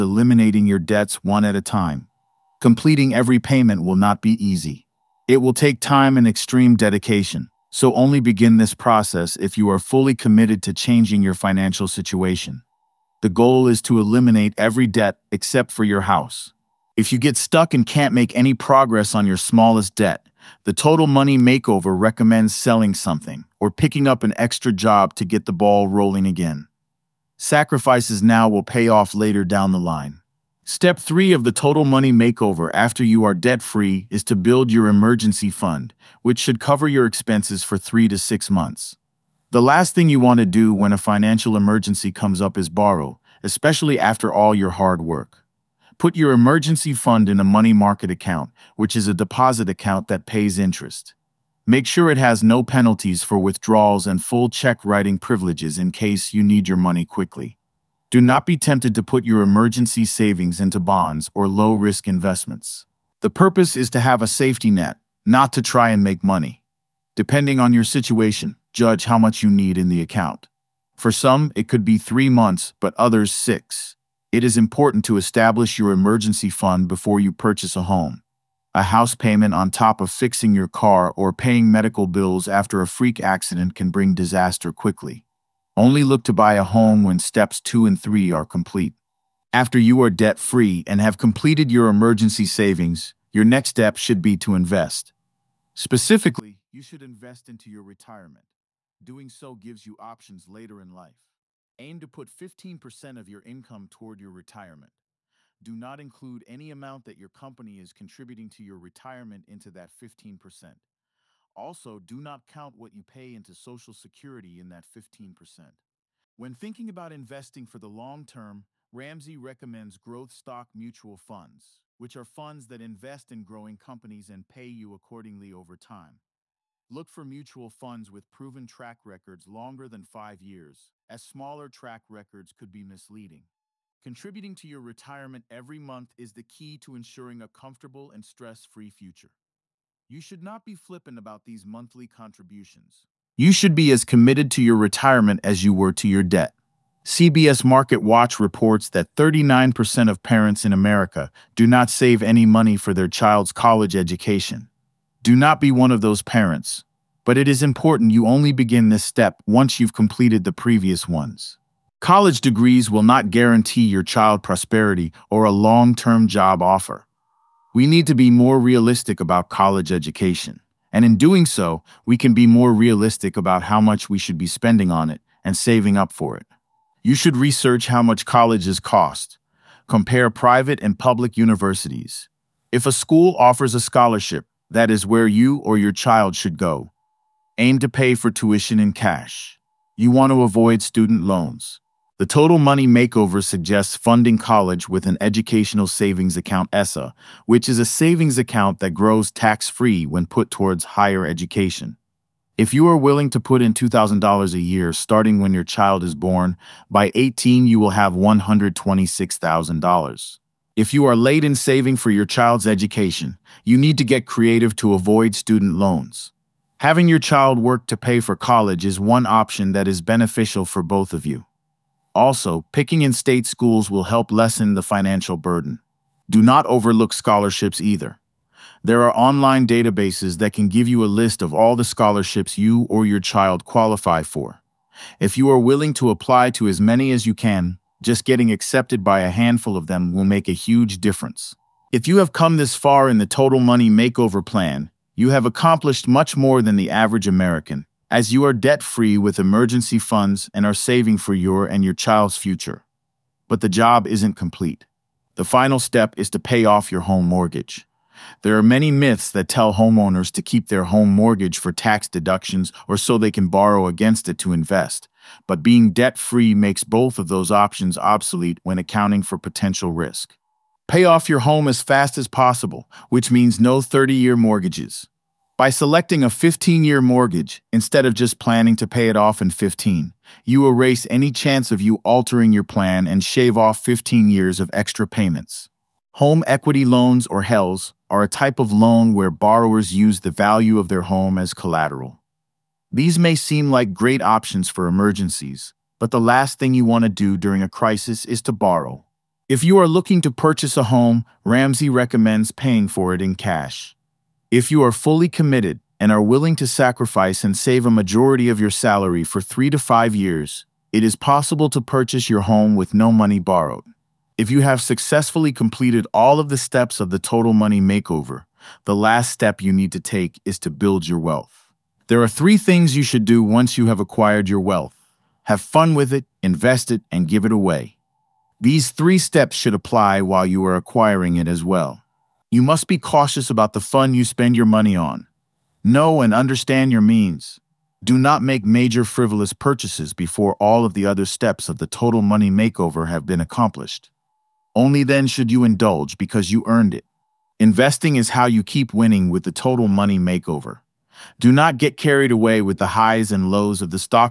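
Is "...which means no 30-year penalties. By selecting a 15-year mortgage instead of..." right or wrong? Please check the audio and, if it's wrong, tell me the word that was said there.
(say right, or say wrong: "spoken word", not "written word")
wrong: "mortgages", not "penalties".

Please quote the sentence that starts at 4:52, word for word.
These may seem like great options for emergencies, but the last thing you want to do during a crisis is to borrow.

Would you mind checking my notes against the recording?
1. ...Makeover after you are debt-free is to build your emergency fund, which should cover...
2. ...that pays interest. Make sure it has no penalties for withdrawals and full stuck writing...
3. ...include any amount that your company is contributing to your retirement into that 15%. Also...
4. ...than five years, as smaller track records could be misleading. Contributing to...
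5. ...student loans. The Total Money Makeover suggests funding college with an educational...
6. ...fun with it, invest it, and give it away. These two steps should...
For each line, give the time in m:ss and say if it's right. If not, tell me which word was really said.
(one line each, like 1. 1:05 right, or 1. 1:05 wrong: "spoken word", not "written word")
1. 0:32 right
2. 0:50 wrong: "check", not "stuck"
3. 1:45 right
4. 2:09 right
5. 3:10 right
6. 5:25 wrong: "three", not "two".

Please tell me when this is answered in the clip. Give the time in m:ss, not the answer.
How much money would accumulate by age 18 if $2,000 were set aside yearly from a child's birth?
3:28.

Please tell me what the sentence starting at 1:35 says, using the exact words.
Specifically, you should invest into your retirement.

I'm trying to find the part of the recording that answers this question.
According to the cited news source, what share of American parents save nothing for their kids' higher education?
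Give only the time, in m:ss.
2:29.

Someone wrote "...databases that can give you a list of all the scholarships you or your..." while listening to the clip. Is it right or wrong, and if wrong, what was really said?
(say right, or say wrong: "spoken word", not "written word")
right.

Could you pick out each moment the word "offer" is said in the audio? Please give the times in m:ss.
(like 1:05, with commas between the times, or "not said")
2:46, 3:03.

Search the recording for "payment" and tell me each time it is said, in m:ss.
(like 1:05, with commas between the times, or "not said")
0:03, 1:19, 4:45.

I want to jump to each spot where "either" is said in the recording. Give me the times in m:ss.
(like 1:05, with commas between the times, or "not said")
3:47.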